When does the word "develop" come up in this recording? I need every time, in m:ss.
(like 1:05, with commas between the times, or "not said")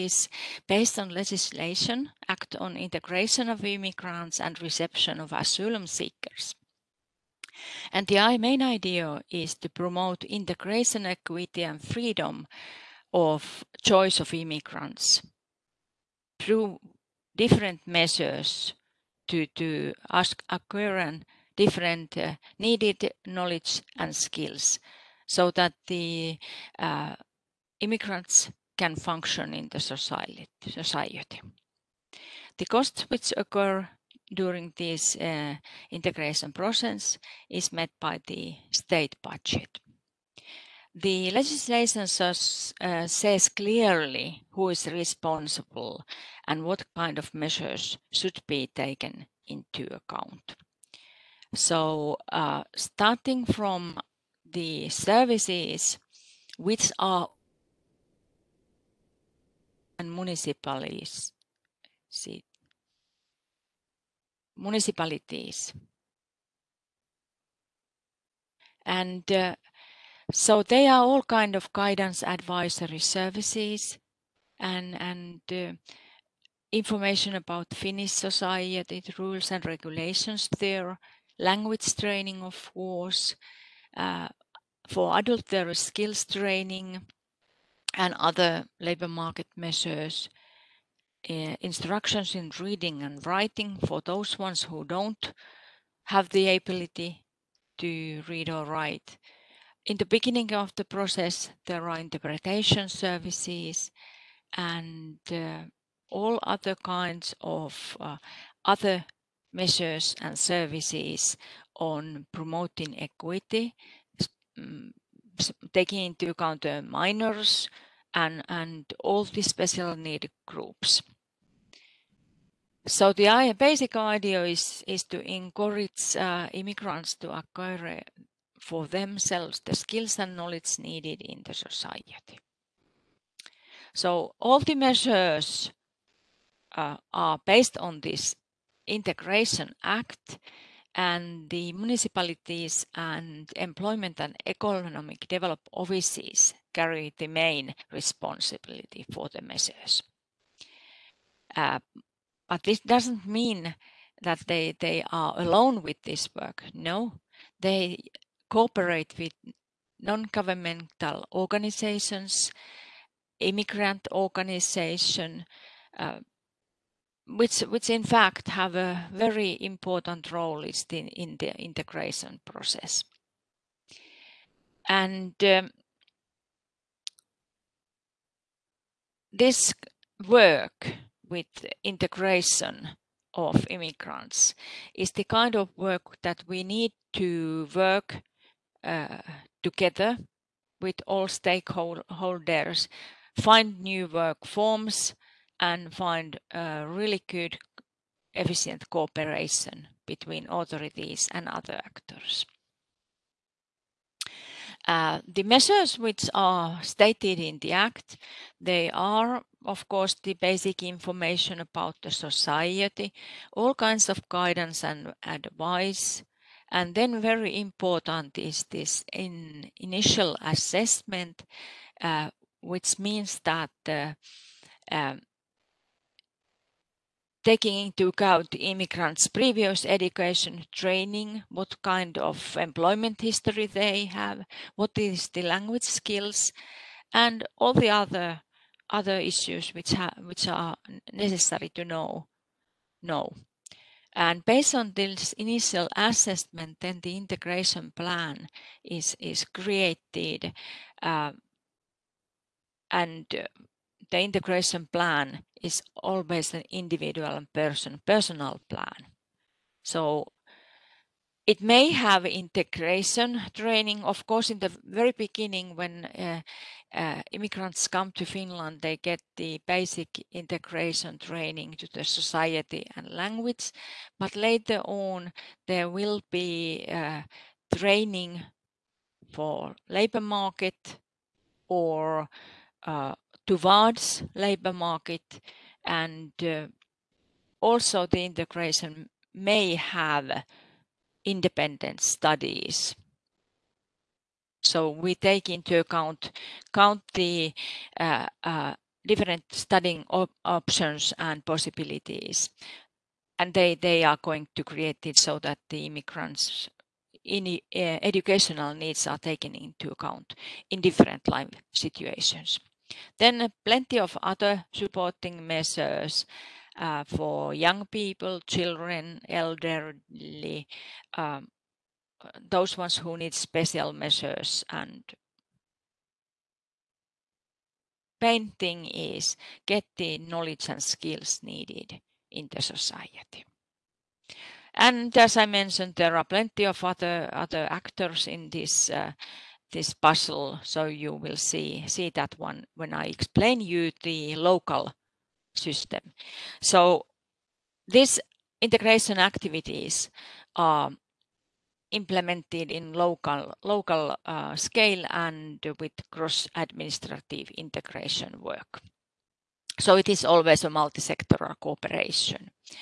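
2:25.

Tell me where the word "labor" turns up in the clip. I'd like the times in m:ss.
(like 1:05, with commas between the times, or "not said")
1:28, 4:39, 4:44.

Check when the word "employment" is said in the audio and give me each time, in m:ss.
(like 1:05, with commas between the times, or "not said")
2:23, 3:52.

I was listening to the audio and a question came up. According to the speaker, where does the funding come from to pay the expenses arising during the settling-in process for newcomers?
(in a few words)
The state budget.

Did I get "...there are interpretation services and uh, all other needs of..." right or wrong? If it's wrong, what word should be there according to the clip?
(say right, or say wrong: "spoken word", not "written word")
wrong: "kinds", not "needs".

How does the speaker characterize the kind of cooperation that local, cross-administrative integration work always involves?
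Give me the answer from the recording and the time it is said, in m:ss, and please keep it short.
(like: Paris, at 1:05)
Multi-sectoral cooperation, at 6:00.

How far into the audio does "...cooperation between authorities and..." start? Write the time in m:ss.
3:18.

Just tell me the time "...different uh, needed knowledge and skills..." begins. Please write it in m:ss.
0:21.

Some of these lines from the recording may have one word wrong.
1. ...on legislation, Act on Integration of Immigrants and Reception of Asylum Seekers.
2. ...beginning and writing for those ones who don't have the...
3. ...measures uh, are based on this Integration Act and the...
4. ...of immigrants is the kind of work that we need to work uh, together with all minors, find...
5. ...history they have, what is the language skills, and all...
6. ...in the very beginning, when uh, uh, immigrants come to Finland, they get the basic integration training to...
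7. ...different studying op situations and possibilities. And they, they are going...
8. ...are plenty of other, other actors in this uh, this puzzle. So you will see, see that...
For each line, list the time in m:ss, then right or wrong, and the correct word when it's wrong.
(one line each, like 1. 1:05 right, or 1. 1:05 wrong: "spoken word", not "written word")
1. 0:00 right
2. 1:32 wrong: "reading", not "beginning"
3. 2:14 right
4. 3:03 wrong: "stakeholders", not "minors"
5. 3:53 right
6. 4:24 right
7. 4:59 wrong: "options", not "situations"
8. 5:36 right.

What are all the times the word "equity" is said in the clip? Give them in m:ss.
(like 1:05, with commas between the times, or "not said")
0:11, 1:52.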